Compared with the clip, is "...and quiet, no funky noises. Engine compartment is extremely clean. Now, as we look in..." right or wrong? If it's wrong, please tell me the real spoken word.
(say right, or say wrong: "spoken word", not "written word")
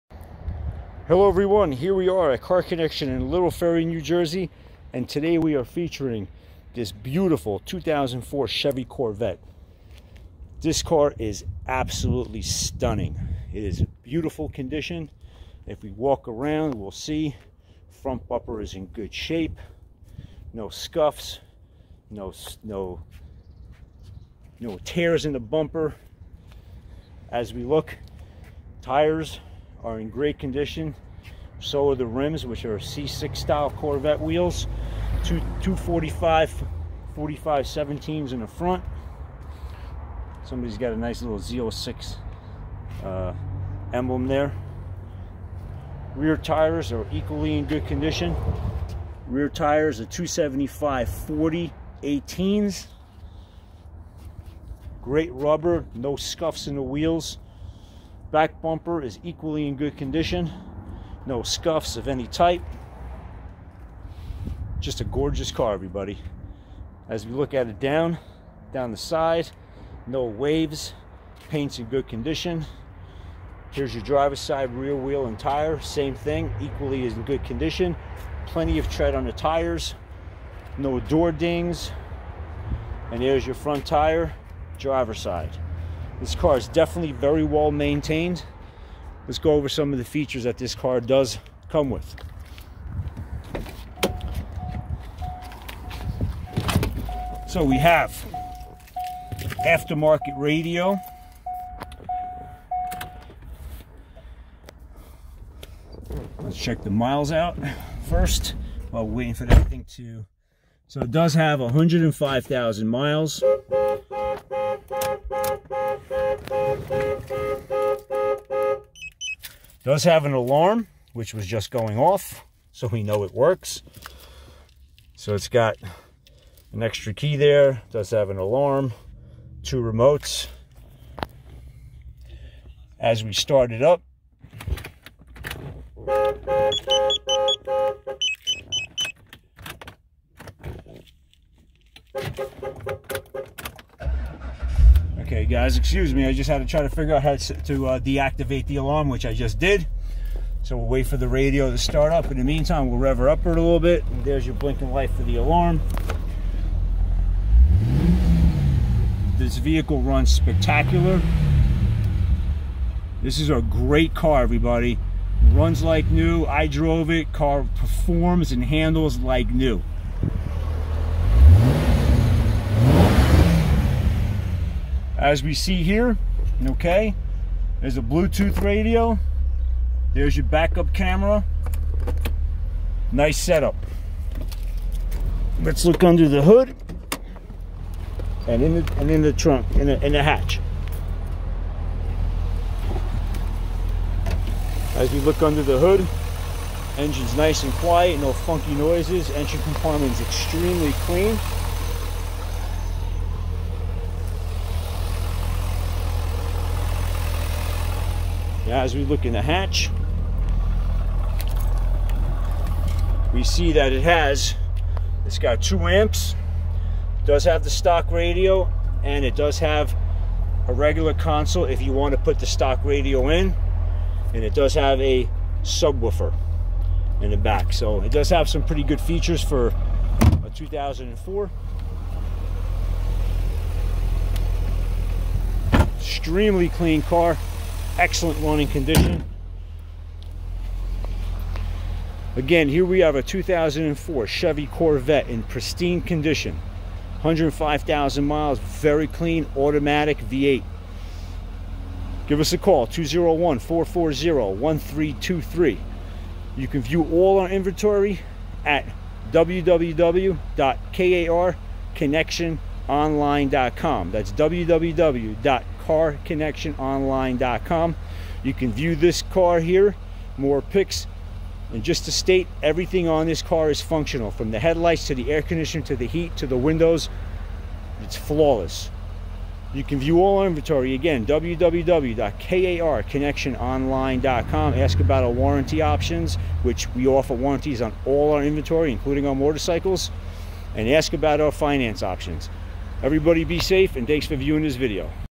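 right.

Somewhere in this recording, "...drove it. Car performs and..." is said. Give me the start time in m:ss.
2:46.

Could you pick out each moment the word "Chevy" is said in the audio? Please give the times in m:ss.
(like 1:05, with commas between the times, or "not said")
0:08, 4:04.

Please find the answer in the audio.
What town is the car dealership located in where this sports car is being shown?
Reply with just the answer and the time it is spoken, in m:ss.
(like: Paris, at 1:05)
Little Ferry, at 0:03.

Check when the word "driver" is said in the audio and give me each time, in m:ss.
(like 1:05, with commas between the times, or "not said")
1:14, 1:24.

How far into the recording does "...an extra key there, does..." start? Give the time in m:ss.
2:06.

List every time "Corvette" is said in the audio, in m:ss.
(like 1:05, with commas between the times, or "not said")
0:08, 0:33, 4:04.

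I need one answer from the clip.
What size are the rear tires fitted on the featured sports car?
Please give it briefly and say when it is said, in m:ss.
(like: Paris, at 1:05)
275 40 18, at 0:50.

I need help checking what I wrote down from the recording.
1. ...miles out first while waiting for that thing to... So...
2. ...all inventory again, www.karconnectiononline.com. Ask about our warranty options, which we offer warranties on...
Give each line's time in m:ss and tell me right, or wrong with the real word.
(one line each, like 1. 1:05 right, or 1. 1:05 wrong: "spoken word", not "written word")
1. 1:46 right
2. 4:40 right.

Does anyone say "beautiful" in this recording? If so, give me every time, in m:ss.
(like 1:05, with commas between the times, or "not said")
0:06, 0:14.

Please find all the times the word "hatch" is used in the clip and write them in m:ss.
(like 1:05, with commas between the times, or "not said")
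3:10, 3:29.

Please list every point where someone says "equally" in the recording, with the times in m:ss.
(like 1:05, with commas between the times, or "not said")
0:47, 0:59, 1:16.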